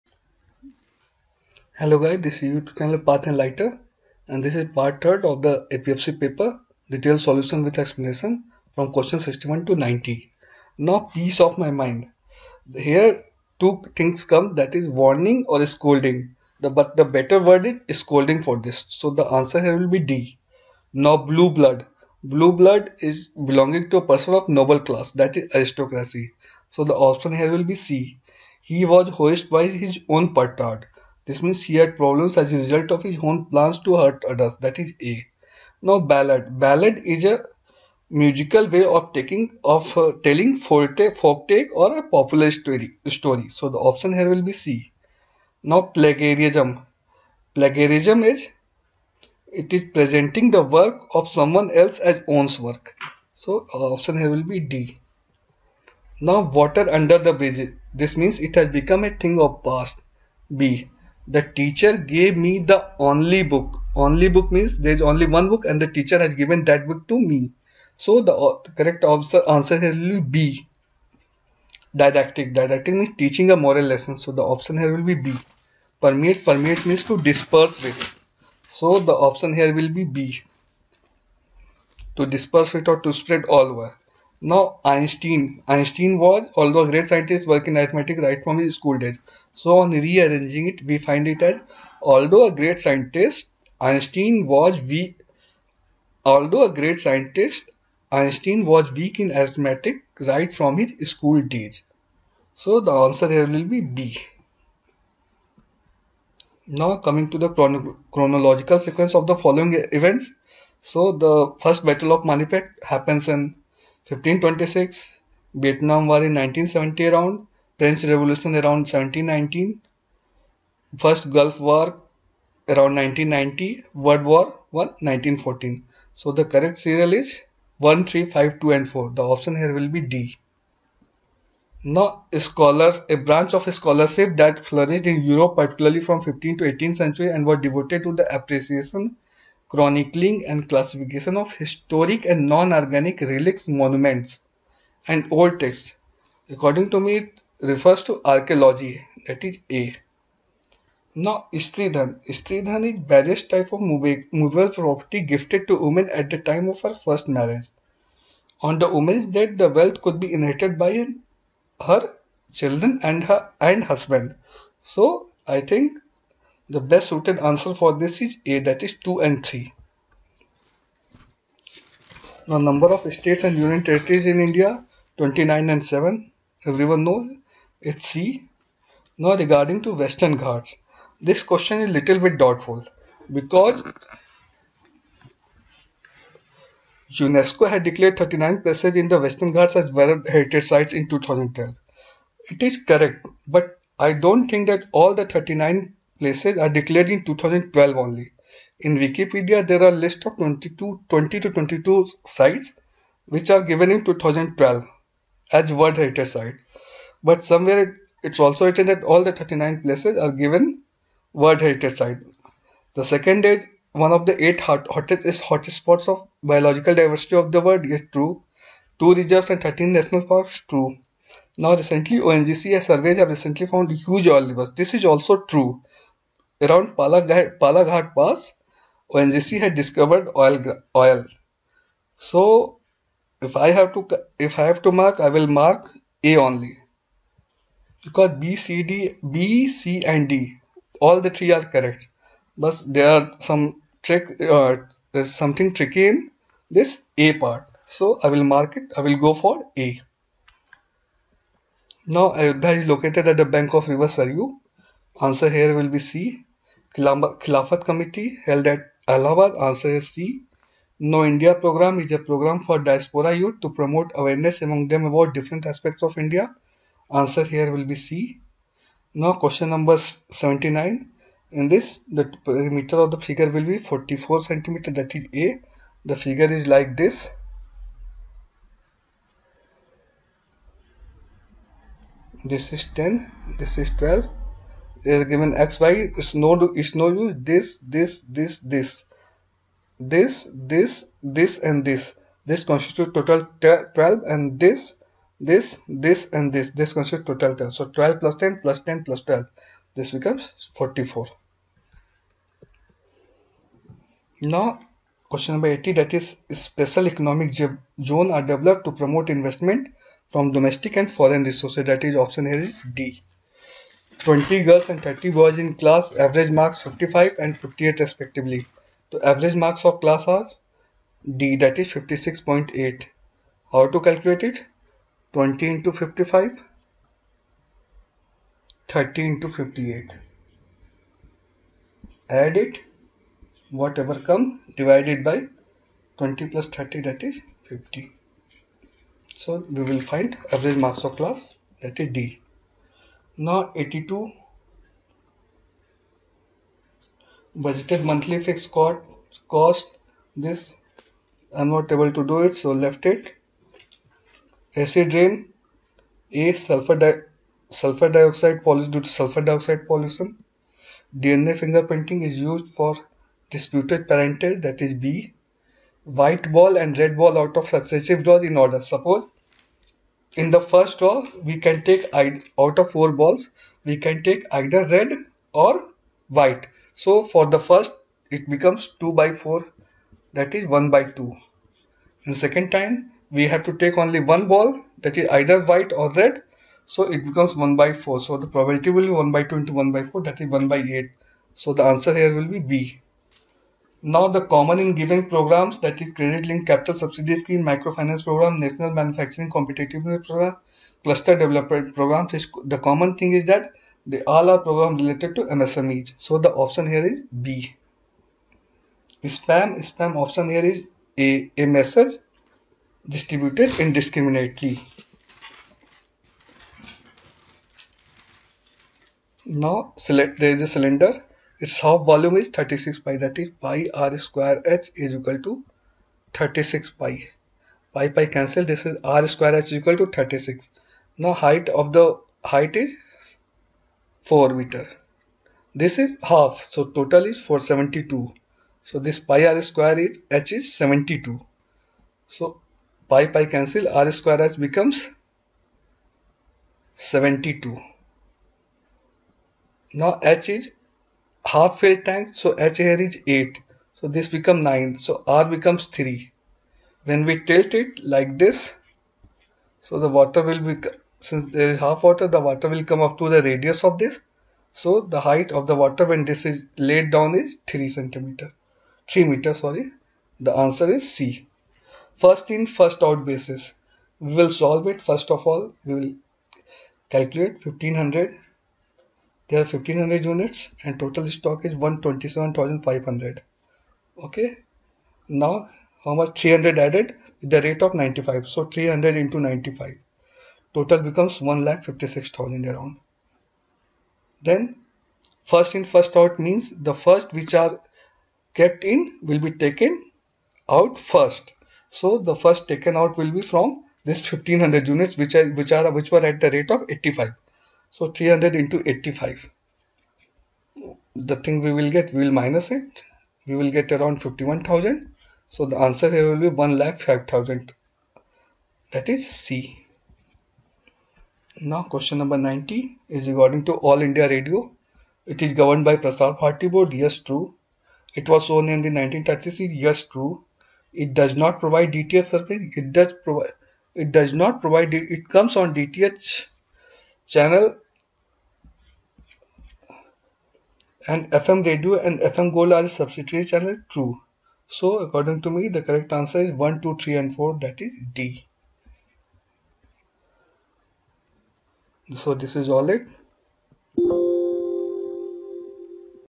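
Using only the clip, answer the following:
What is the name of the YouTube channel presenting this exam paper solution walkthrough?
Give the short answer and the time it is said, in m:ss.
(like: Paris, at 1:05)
Path Enlighter, at 0:02.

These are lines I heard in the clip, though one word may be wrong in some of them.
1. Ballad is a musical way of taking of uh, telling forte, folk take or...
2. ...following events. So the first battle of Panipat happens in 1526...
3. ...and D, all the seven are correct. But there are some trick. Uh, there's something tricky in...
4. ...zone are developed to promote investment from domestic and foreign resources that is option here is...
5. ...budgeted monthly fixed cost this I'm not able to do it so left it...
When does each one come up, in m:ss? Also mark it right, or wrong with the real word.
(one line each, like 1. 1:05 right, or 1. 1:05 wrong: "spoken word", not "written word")
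1. 0:36 right
2. 1:49 right
3. 4:00 wrong: "three", not "seven"
4. 5:08 right
5. 5:47 right.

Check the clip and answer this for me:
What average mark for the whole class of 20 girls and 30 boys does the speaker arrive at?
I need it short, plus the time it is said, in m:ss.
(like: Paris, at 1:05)
56.8, at 5:21.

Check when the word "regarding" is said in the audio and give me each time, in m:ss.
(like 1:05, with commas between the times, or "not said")
2:59, 8:43.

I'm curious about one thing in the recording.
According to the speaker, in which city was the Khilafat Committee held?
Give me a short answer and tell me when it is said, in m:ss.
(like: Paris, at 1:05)
Allahabad, at 4:19.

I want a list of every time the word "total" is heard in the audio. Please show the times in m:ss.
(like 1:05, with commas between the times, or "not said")
4:53, 4:57, 7:16, 8:00, 8:10.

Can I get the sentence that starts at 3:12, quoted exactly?
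It is correct but I don't think that all the 39 places are declared in 2012 only.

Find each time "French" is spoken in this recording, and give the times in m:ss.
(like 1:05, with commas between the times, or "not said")
1:57.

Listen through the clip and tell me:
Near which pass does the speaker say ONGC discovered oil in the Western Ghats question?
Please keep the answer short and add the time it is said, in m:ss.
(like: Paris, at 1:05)
Palaghat Pass, at 3:47.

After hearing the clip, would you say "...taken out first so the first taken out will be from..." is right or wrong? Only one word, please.
right.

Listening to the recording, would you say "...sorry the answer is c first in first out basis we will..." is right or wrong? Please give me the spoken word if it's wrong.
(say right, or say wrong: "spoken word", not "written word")
right.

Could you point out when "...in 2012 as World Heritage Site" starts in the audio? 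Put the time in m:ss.
3:23.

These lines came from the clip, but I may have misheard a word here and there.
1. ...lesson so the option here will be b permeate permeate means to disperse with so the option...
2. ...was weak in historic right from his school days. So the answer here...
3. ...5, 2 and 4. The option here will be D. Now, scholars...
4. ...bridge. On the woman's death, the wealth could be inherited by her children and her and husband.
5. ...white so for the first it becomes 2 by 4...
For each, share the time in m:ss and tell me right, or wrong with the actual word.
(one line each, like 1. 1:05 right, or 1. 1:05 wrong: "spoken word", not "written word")
1. 1:13 right
2. 1:38 wrong: "arithmetic", not "historic"
3. 2:08 right
4. 2:37 wrong: "marriage", not "bridge"
5. 6:16 right.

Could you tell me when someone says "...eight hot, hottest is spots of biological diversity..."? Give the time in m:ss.
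3:34.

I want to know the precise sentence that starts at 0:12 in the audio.
Here two things come that is warning or scolding.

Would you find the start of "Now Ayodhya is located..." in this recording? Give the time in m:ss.
4:12.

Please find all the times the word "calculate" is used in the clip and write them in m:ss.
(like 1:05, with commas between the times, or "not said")
5:23, 7:57.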